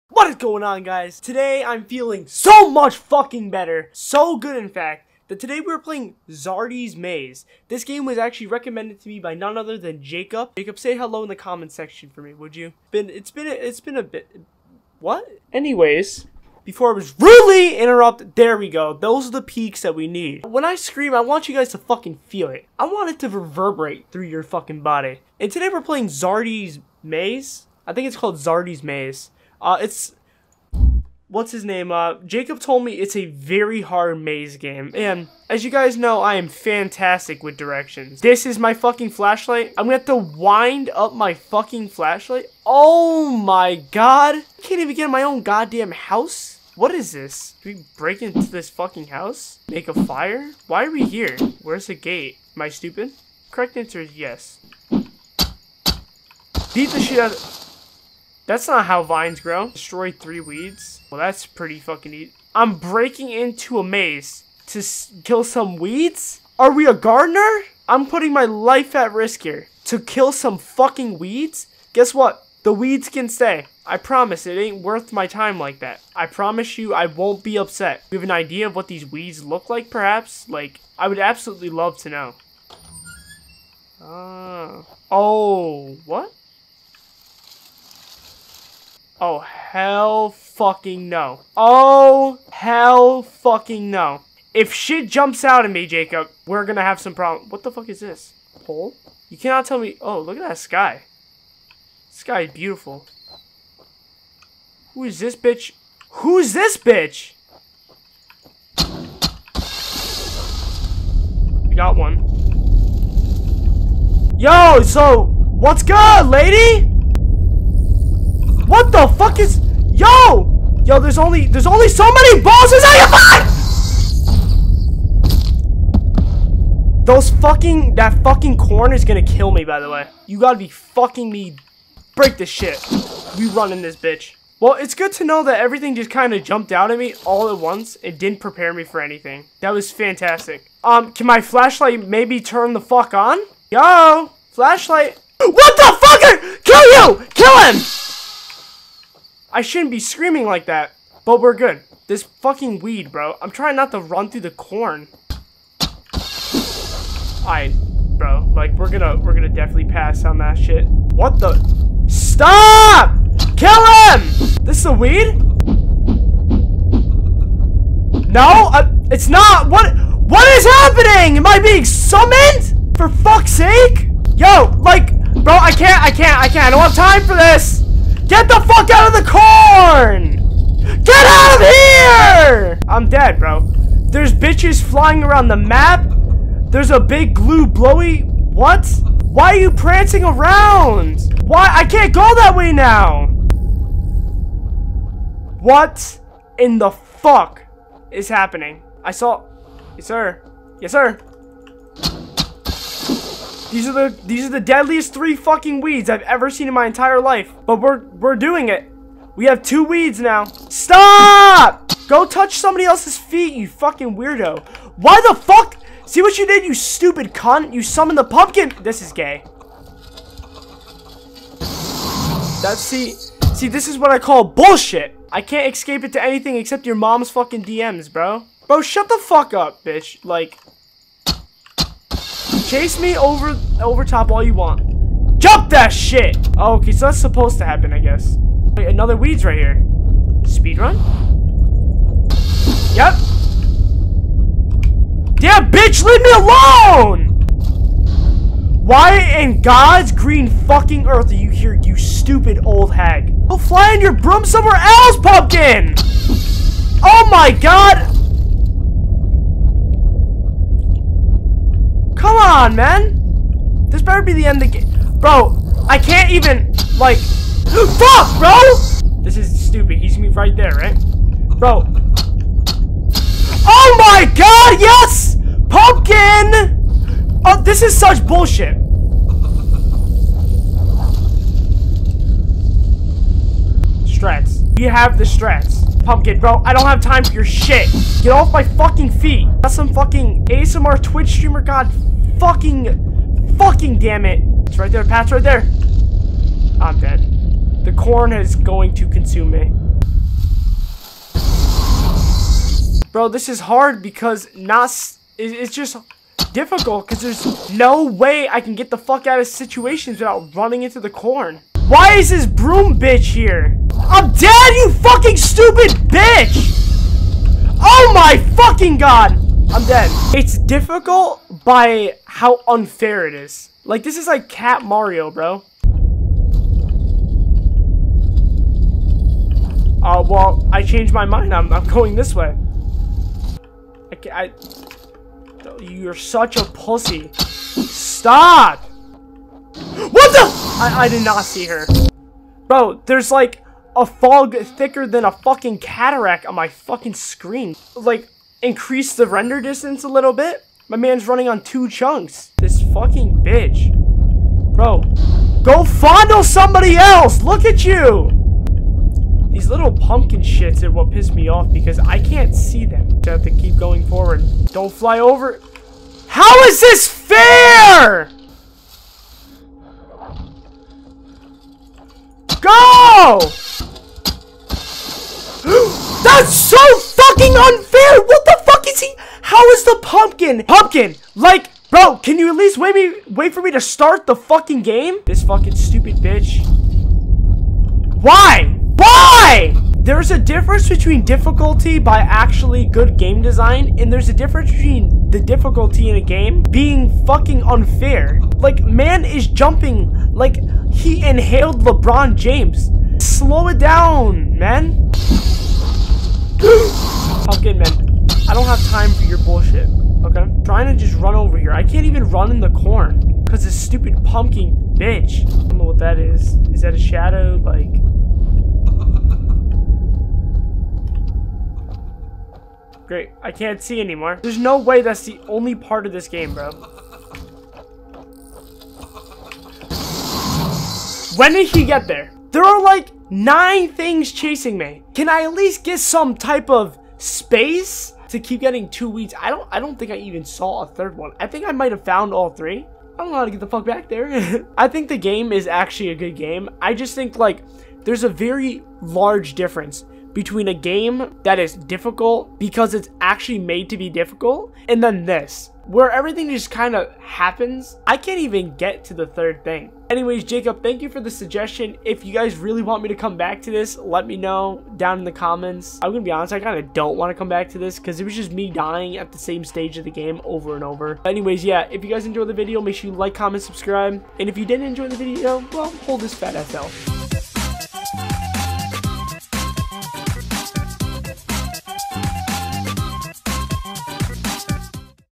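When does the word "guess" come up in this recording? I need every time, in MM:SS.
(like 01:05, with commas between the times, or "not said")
01:11, 03:57.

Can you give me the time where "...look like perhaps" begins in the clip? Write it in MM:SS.
01:19.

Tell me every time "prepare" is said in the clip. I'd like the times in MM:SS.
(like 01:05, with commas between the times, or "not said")
02:18.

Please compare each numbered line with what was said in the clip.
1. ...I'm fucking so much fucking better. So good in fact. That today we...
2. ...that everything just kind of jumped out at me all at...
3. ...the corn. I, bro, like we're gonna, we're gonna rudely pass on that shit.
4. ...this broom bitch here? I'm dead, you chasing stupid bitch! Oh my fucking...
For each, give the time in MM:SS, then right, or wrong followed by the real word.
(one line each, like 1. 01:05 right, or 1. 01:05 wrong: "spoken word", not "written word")
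1. 00:01 wrong: "feeling", not "fucking"
2. 02:15 right
3. 02:34 wrong: "definitely", not "rudely"
4. 05:12 wrong: "fucking", not "chasing".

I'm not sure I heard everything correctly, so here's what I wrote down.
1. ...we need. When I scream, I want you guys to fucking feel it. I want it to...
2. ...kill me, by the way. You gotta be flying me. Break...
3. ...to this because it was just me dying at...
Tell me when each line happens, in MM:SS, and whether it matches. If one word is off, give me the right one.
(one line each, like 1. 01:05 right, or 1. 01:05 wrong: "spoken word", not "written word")
1. 00:19 right
2. 02:09 wrong: "fucking", not "flying"
3. 07:47 right.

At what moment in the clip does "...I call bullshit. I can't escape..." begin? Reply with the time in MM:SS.
03:44.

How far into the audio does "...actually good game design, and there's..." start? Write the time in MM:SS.
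06:32.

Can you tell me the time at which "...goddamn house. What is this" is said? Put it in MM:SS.
00:45.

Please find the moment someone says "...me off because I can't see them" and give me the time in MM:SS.
06:01.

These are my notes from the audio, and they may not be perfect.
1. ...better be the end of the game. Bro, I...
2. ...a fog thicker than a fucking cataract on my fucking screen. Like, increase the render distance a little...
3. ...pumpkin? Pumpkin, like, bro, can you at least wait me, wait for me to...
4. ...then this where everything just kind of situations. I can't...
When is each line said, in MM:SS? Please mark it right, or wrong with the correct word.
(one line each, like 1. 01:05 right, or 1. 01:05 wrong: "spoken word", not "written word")
1. 04:24 right
2. 05:43 right
3. 06:20 right
4. 07:35 wrong: "happens", not "situations".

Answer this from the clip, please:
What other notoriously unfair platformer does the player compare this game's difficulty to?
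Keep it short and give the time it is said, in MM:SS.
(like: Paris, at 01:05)
Cat Mario, at 05:24.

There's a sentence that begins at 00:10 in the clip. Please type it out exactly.
Jacob, say hello in the comments section for me, would you?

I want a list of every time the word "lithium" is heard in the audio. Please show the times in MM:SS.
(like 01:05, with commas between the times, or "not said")
not said.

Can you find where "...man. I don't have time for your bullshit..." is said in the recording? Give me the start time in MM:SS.
06:47.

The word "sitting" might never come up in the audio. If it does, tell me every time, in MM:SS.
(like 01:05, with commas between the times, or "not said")
not said.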